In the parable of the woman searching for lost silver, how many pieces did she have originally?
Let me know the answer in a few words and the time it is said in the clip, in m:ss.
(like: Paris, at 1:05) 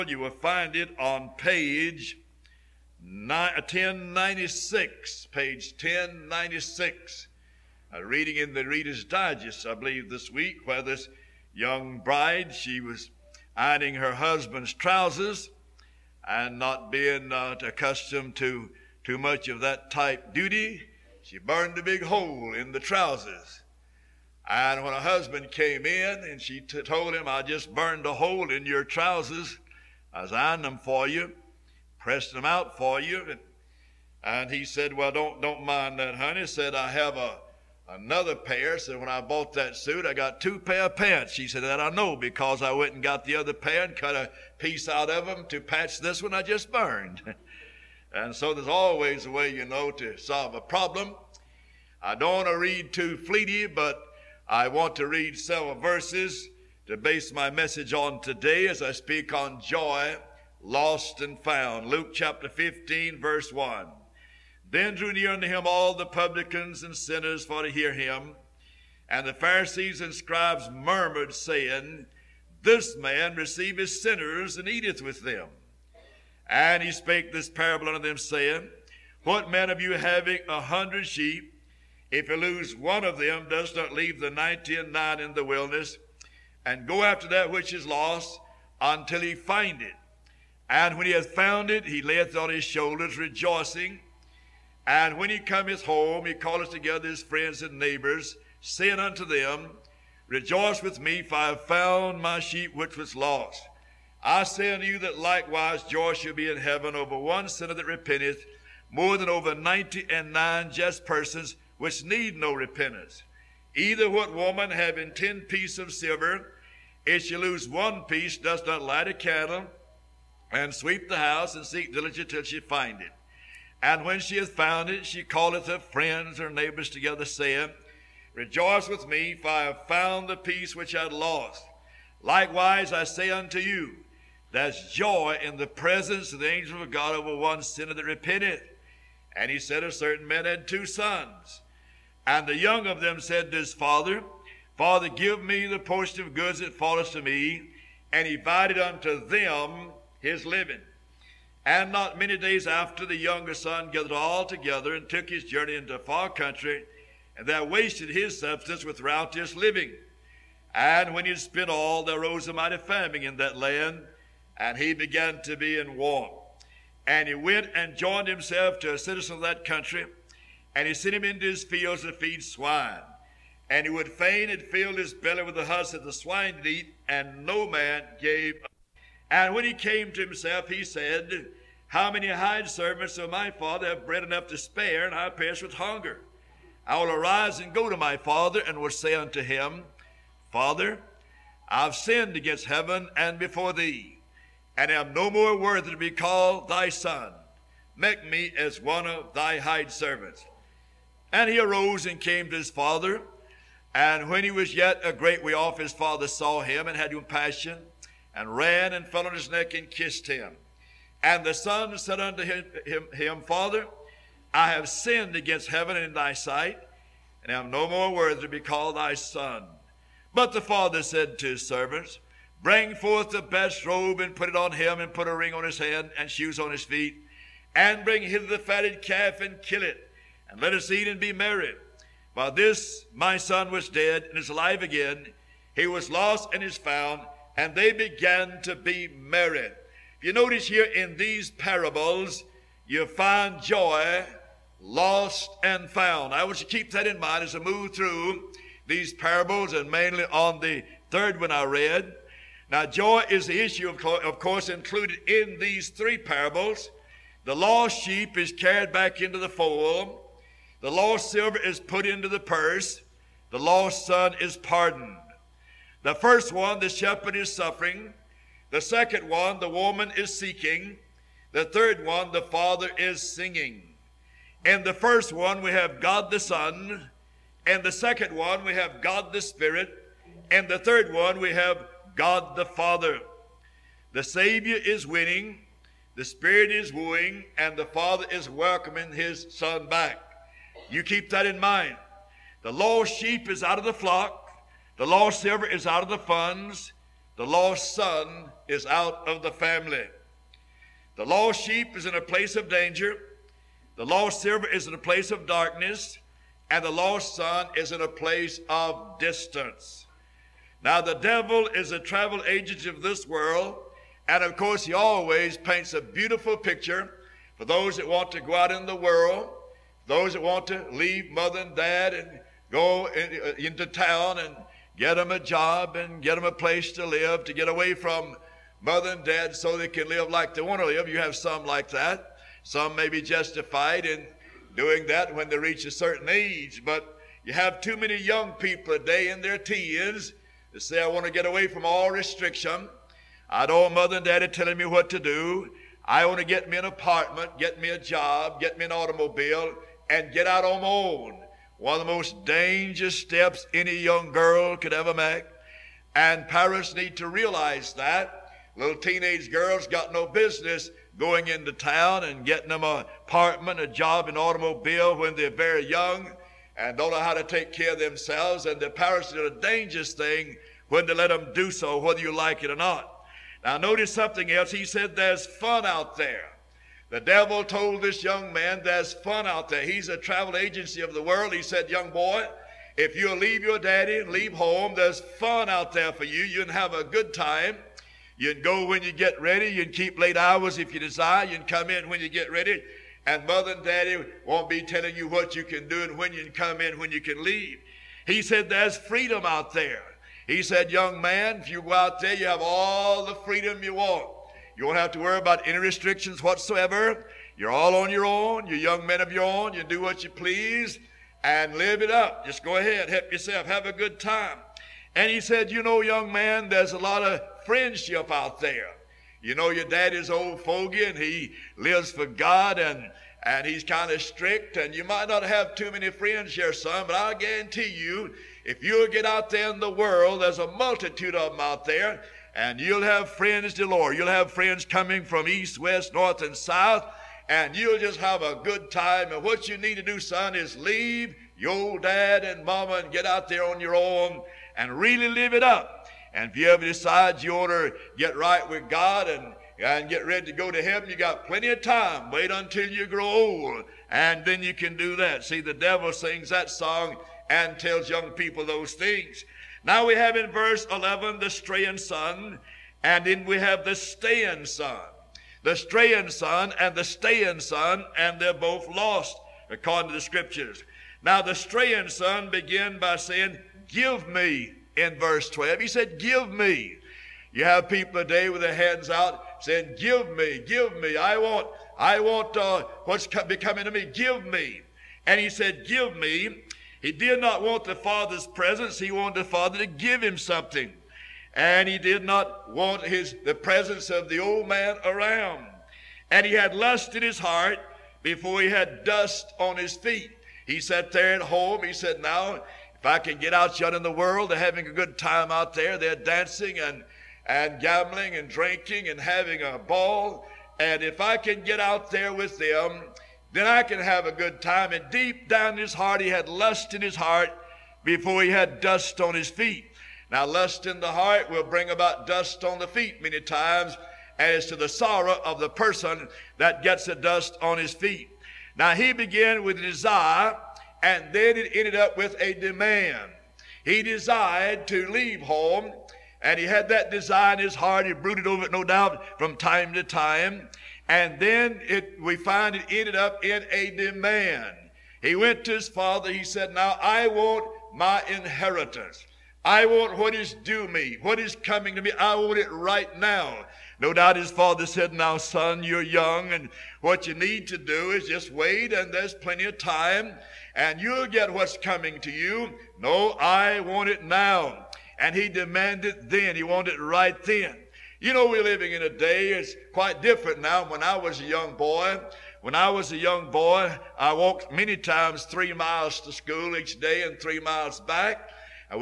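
10, at 1:55.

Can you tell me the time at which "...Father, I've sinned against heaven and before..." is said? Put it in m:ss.
3:10.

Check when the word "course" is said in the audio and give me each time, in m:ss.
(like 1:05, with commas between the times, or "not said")
4:14, 5:14.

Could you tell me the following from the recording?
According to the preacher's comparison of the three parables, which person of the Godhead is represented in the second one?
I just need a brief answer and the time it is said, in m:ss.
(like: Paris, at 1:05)
God the Spirit, at 4:39.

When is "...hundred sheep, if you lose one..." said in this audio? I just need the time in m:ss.
1:20.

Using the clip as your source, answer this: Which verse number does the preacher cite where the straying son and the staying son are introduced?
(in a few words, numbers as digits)
Verse 11.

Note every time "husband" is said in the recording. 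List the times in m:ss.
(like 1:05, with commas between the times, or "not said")
0:14, 0:24.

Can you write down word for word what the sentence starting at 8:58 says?
He brooded over it, no doubt, from time to time.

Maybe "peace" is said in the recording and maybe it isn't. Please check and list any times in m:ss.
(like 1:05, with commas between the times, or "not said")
2:10.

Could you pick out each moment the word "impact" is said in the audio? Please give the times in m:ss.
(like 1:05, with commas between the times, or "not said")
not said.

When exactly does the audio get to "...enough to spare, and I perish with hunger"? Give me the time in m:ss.
3:04.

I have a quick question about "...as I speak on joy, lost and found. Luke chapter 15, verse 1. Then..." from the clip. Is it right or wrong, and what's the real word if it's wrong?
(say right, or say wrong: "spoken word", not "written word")
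right.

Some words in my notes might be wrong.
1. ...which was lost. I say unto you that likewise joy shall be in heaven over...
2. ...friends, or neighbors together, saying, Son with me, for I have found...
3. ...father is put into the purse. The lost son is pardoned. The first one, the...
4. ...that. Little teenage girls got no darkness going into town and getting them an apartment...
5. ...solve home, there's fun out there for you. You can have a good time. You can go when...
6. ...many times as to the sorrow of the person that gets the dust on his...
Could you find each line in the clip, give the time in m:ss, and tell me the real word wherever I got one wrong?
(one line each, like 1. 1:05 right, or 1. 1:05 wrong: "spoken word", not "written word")
1. 1:42 right
2. 2:05 wrong: "Rejoice", not "Son"
3. 4:21 wrong: "silver", not "father"
4. 5:57 wrong: "business", not "darkness"
5. 6:24 wrong: "leave", not "solve"
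6. 8:43 right.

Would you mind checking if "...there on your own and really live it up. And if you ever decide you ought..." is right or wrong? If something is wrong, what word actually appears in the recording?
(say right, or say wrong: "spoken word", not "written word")
right.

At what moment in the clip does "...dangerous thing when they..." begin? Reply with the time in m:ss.
6:09.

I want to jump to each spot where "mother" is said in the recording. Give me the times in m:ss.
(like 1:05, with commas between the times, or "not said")
5:21, 5:28, 5:43, 6:33.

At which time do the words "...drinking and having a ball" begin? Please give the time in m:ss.
8:28.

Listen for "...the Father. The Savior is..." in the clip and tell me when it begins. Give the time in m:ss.
4:42.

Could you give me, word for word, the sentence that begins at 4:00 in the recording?
If you notice here in these parables, you find joy, lost, and found.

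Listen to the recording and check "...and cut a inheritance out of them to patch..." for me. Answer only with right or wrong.
wrong.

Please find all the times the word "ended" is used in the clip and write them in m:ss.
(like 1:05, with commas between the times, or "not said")
8:51, 9:02.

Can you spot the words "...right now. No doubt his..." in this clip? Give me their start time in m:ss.
9:12.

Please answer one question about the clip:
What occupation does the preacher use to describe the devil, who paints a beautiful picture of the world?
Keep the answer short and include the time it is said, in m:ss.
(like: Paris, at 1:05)
Travel agent, at 5:11.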